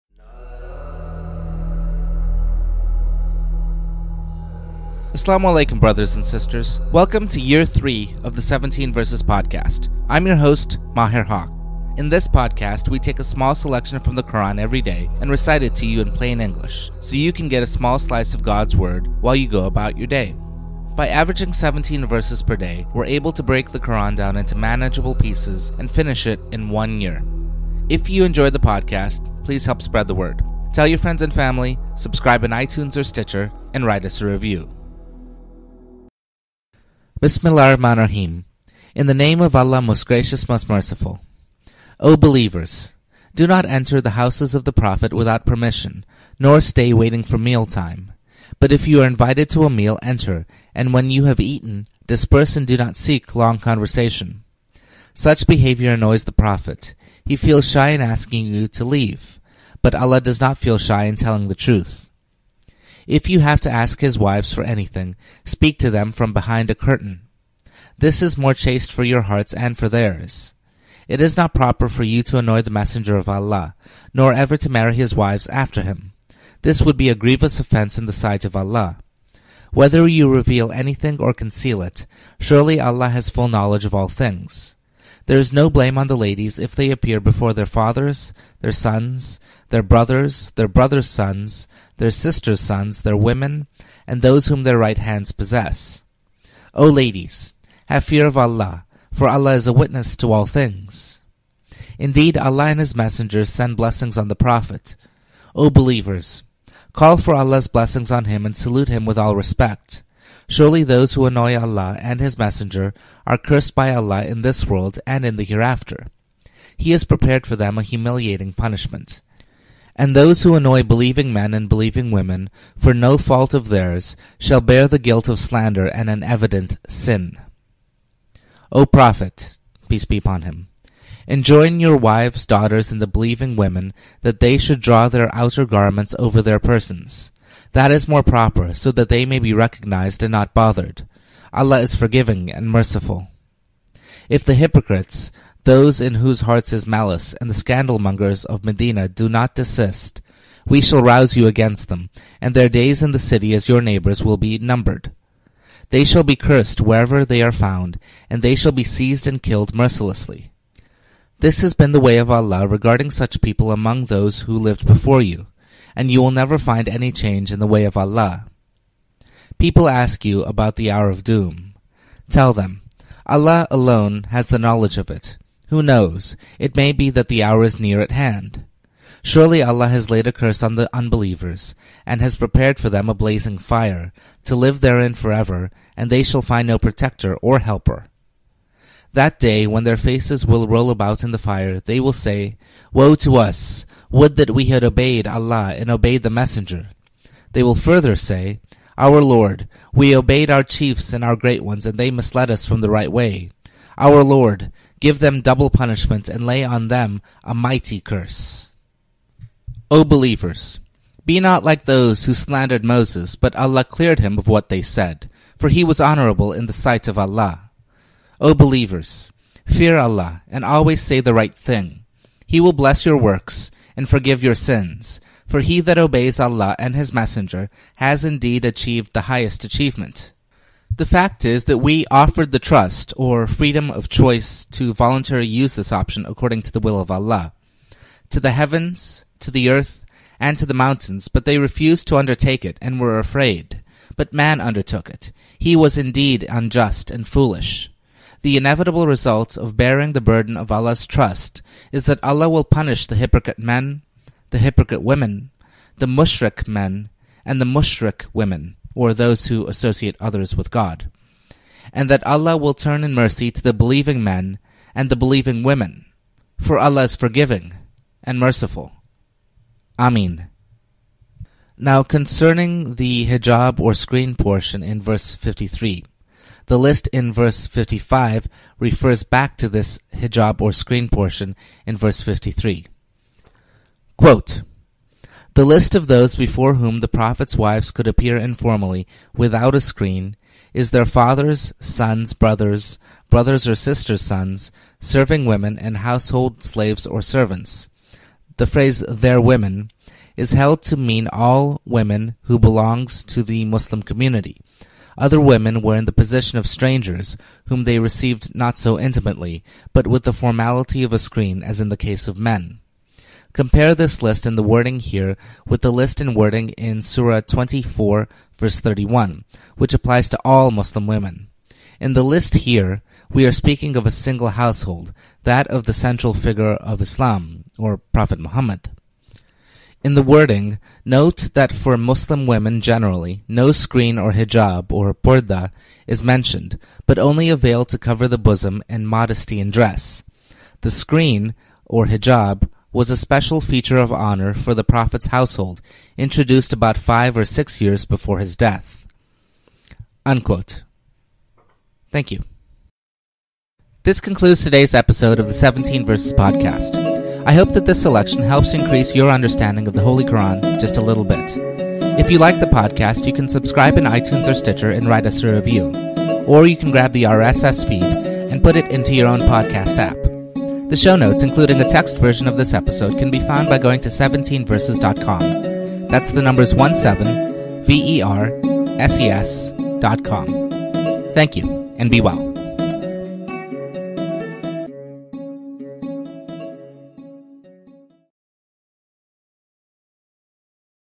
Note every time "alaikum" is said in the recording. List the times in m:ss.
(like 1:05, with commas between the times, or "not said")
0:05.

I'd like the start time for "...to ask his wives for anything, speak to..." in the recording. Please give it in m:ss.
1:03.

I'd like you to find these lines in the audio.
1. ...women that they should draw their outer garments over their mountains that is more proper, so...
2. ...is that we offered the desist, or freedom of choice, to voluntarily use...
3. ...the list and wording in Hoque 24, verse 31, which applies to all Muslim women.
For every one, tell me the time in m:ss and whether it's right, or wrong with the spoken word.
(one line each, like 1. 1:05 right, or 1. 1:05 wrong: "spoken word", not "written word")
1. 2:13 wrong: "persons", not "mountains"
2. 3:51 wrong: "trust", not "desist"
3. 5:15 wrong: "Surah", not "Hoque".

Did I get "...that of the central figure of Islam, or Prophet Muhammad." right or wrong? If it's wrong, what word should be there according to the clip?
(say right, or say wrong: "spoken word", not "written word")
right.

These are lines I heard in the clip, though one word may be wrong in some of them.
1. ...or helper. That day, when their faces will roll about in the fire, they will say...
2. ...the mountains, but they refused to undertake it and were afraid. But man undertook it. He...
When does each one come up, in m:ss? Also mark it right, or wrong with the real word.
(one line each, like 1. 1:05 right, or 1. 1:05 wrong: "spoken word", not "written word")
1. 3:07 right
2. 4:00 right.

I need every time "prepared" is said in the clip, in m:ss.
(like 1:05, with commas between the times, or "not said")
1:57, 3:02.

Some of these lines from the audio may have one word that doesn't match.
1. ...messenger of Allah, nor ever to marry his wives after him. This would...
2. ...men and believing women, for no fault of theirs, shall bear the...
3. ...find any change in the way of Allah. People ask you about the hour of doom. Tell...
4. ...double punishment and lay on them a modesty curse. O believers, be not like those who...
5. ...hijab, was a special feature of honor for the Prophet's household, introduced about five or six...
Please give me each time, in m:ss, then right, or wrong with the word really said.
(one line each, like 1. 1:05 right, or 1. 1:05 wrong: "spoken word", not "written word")
1. 1:12 right
2. 2:01 right
3. 2:46 right
4. 3:25 wrong: "mighty", not "modesty"
5. 5:42 right.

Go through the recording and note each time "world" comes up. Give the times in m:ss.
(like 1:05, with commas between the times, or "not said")
1:54.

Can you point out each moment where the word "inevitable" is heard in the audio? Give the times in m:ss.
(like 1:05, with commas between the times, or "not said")
4:08.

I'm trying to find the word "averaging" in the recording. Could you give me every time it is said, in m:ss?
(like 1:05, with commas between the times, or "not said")
0:21.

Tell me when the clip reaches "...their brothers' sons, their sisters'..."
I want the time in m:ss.
1:30.